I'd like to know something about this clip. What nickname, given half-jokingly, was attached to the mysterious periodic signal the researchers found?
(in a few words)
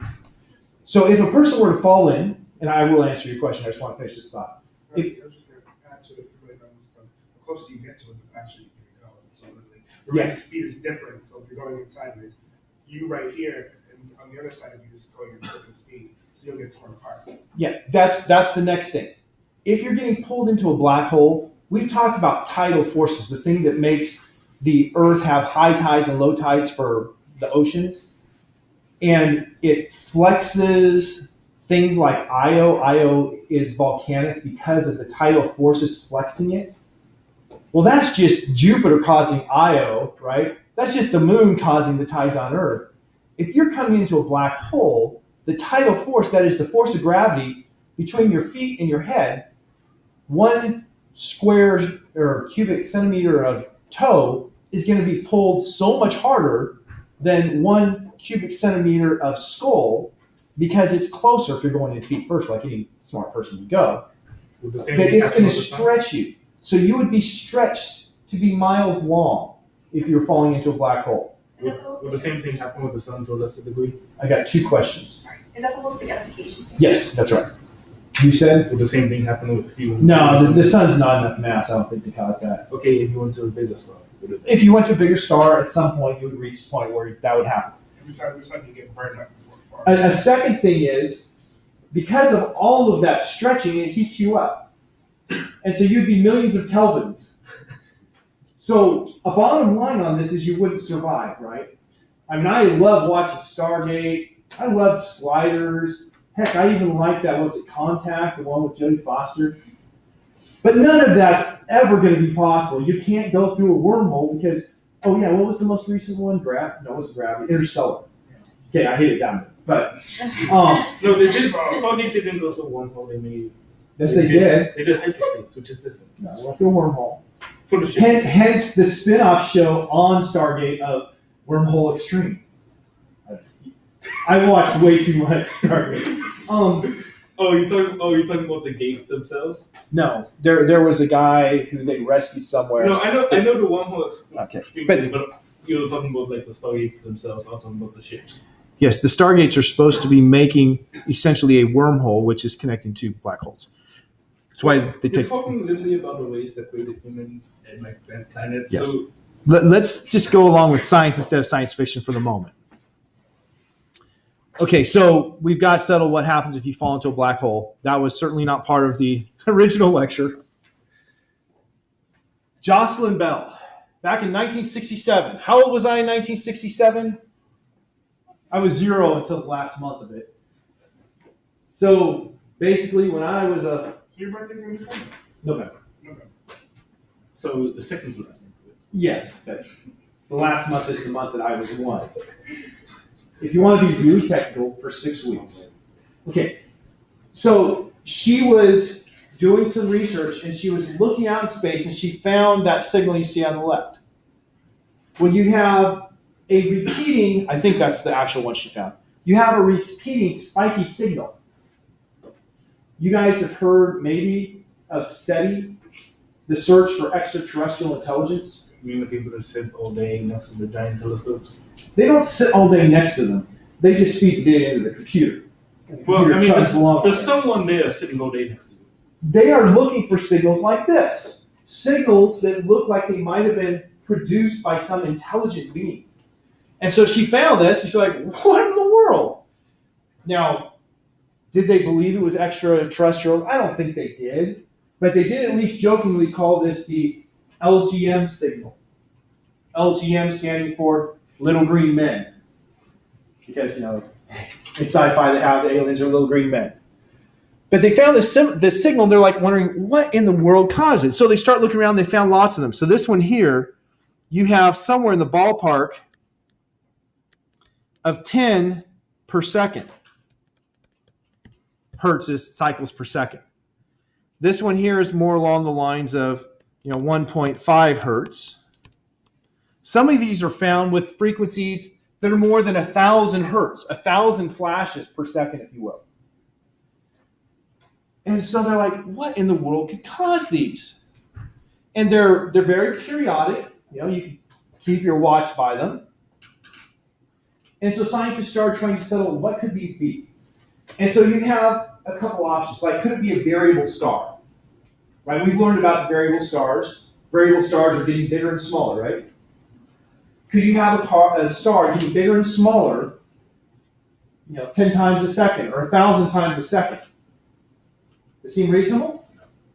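LGM signal.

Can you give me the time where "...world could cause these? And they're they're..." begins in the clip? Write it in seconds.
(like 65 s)
289 s.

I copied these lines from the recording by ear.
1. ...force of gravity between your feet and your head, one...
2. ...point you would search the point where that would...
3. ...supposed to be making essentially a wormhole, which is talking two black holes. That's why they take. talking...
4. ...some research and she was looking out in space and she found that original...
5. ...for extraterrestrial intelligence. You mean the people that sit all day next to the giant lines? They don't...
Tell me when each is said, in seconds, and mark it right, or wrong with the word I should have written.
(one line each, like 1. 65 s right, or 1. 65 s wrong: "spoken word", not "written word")
1. 46 s right
2. 85 s wrong: "reach", not "search"
3. 149 s wrong: "connecting", not "talking"
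4. 199 s wrong: "signal", not "original"
5. 216 s wrong: "telescopes", not "lines".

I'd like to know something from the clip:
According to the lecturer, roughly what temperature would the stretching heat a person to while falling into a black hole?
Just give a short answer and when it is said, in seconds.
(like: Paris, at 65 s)
millions of kelvins, at 96 s.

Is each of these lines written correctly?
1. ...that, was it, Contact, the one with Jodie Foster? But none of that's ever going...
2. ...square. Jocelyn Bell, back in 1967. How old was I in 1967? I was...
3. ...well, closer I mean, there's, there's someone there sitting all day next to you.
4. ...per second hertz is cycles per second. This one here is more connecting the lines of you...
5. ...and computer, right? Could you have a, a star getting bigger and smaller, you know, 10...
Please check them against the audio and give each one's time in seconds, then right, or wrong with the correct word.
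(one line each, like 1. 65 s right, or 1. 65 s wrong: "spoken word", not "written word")
1. 107 s right
2. 169 s wrong: "lecture", not "square"
3. 226 s wrong: "computer", not "closer"
4. 269 s wrong: "along", not "connecting"
5. 308 s wrong: "smaller", not "computer".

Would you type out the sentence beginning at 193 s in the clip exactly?
If you want to be really technical, for six weeks.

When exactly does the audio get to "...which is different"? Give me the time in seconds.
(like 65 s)
125 s.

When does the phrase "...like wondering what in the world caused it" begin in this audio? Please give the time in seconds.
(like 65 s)
259 s.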